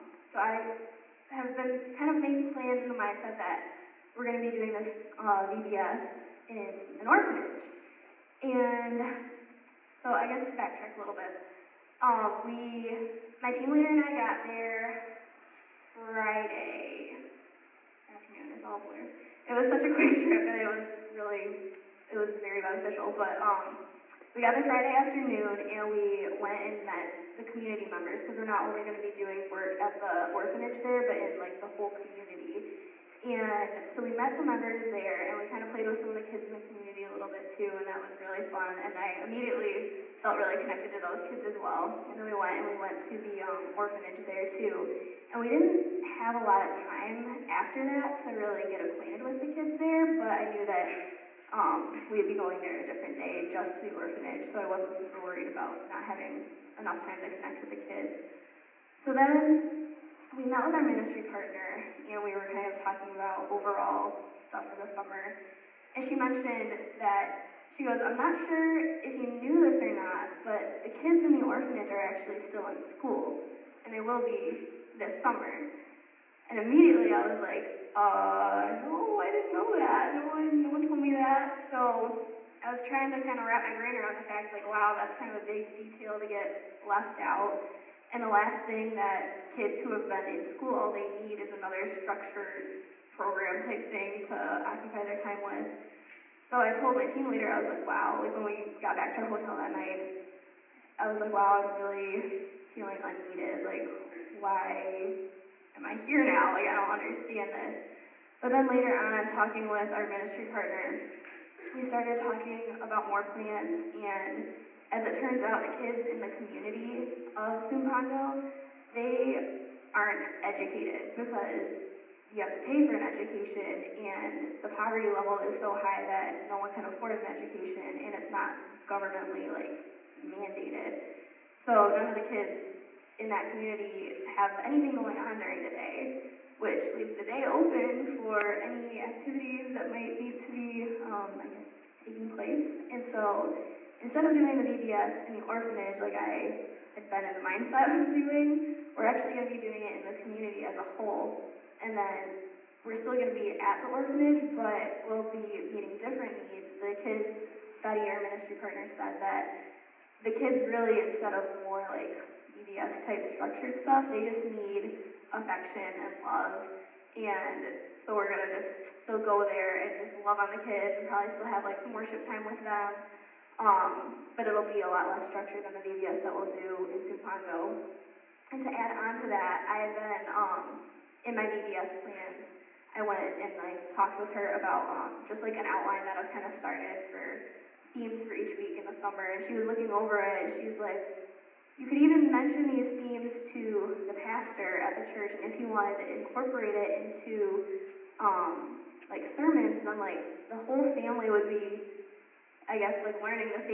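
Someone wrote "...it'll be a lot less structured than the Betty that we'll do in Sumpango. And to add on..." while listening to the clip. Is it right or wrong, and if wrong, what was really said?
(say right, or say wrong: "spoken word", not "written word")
wrong: "VBS", not "Betty".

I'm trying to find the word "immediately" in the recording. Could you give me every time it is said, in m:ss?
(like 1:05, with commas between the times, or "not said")
0:39, 1:16.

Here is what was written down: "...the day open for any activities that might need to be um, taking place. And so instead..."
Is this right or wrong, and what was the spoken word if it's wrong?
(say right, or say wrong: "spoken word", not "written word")
right.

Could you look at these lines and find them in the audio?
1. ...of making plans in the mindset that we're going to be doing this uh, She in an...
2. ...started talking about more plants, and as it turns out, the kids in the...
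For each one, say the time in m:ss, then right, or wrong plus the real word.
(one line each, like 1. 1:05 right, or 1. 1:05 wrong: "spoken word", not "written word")
1. 0:02 wrong: "VBS", not "She"
2. 1:51 right.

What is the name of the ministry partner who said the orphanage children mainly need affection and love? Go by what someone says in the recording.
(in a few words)
Betty.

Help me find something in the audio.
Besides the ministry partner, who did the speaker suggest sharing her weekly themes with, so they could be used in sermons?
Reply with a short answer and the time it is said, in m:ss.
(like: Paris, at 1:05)
the pastor, at 3:14.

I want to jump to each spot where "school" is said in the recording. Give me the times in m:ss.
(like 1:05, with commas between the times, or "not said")
1:12, 1:30.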